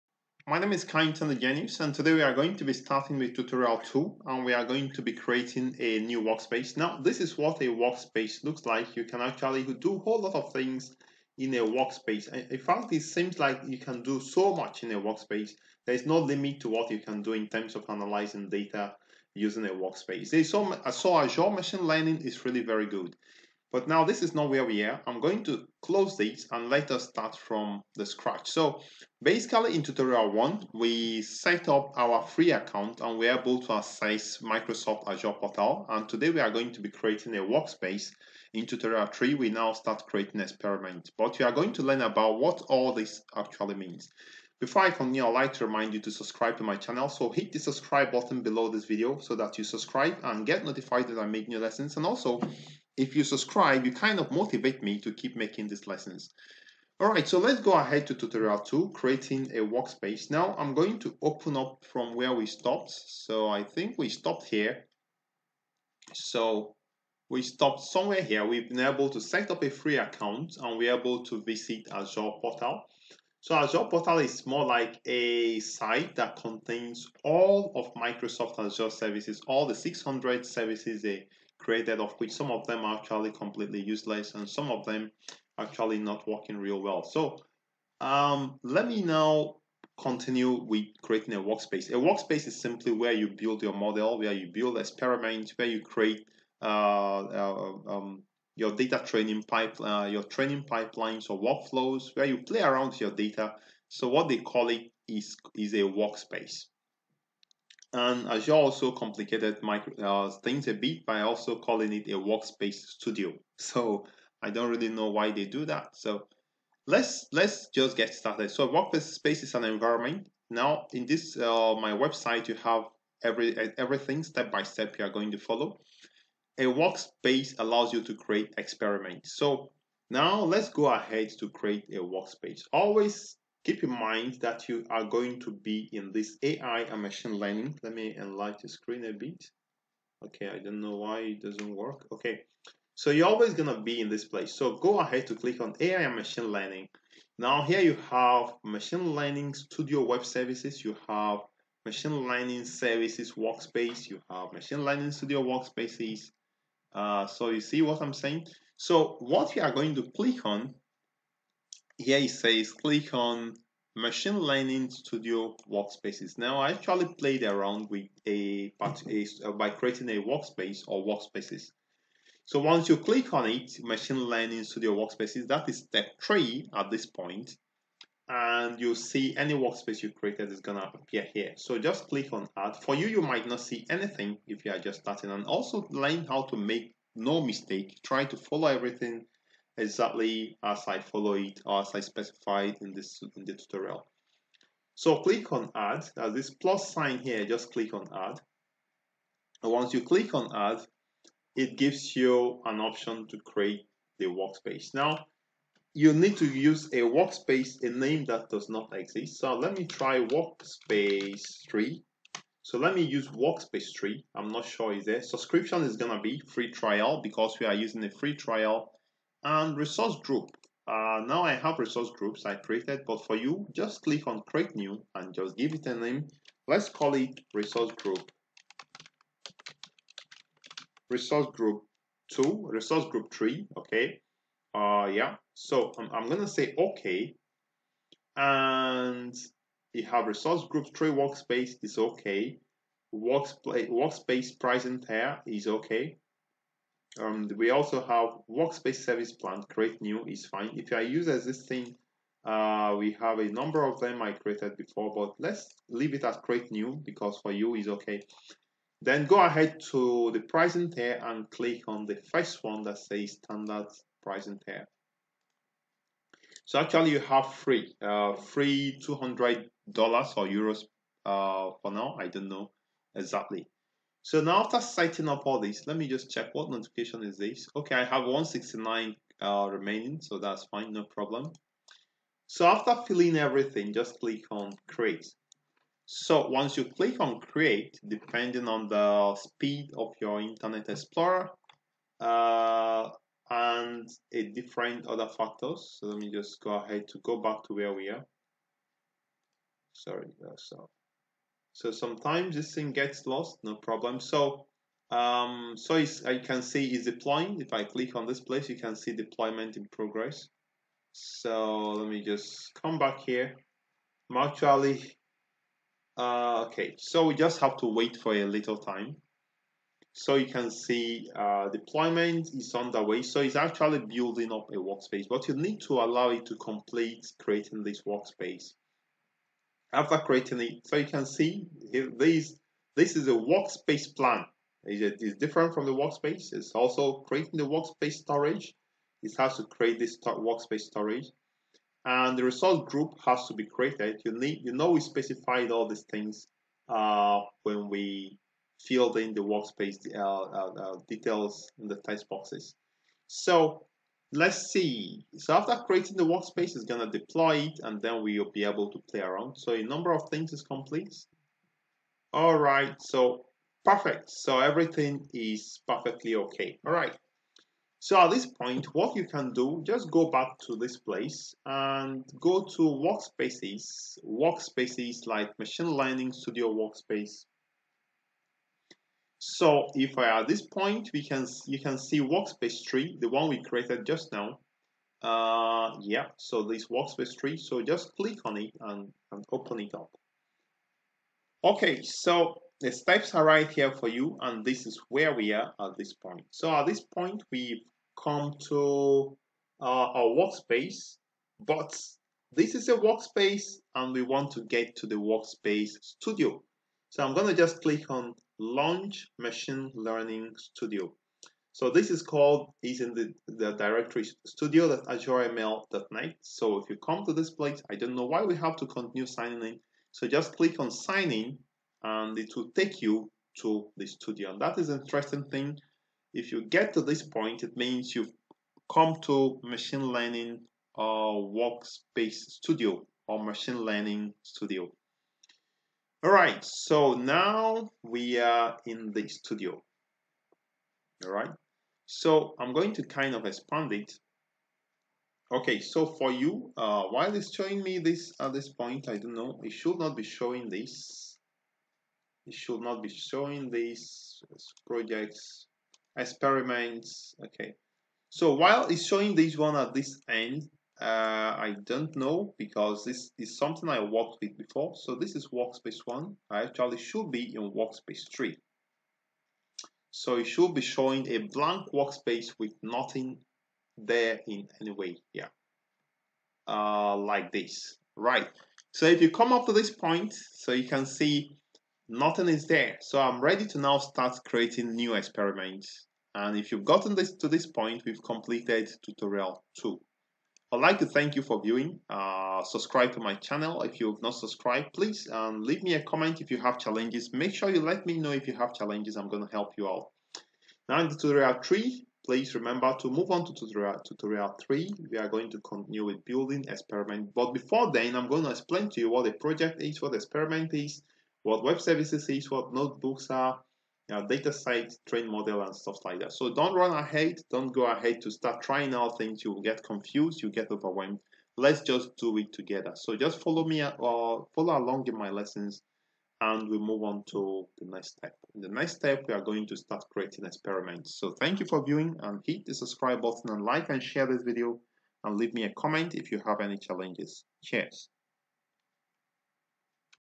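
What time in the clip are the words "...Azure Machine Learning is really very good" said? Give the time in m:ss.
0:21.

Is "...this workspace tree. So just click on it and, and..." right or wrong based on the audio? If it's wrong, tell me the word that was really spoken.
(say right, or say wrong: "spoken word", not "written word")
right.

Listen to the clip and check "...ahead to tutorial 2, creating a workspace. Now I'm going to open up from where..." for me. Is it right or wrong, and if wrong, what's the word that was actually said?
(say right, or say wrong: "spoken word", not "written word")
right.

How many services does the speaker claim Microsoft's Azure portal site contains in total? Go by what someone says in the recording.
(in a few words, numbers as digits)
600.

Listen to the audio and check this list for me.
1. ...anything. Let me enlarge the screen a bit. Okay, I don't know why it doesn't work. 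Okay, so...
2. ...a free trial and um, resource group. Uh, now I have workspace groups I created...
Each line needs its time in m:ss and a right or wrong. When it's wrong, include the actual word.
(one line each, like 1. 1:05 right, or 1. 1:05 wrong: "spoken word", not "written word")
1. 2:17 wrong: "learning", not "anything"
2. 3:38 wrong: "resource", not "workspace".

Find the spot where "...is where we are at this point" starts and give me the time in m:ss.
6:34.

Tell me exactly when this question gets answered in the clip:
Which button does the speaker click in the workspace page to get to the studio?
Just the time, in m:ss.
6:48.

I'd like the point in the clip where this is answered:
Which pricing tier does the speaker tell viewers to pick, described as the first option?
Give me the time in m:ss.
4:23.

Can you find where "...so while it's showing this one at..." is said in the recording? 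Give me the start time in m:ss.
7:38.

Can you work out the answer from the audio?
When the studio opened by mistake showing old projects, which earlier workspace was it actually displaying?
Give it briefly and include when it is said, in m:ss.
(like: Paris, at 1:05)
Workspace 1, at 7:45.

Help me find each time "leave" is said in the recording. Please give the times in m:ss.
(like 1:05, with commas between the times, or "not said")
4:15, 8:15, 8:55.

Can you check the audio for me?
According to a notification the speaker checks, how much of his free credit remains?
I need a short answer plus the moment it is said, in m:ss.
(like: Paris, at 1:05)
169, at 4:38.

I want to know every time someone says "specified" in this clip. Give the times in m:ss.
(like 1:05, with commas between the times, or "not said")
3:12, 5:45.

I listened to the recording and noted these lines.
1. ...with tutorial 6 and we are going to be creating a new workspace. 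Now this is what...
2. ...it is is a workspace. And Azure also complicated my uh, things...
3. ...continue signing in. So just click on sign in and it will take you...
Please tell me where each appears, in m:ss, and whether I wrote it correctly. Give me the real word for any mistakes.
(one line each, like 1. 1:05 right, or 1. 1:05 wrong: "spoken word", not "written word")
1. 0:03 wrong: "2", not "6"
2. 1:44 right
3. 6:58 right.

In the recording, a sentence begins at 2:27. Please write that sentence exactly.
Now here you have machine learning studio web services.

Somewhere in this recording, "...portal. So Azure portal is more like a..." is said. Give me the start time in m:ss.
1:12.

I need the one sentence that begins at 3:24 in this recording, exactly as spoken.
Now, you need to use a workspace, a name that does not exist.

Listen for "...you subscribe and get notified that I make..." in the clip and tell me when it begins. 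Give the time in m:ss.
0:49.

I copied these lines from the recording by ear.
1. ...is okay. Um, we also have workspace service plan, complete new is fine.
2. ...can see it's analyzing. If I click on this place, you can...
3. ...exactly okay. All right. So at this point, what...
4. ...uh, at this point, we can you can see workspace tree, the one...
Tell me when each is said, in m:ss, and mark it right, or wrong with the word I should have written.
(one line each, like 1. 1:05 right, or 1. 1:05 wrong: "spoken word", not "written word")
1. 4:05 wrong: "create", not "complete"
2. 5:06 wrong: "deploying", not "analyzing"
3. 6:05 wrong: "perfectly", not "exactly"
4. 6:20 right.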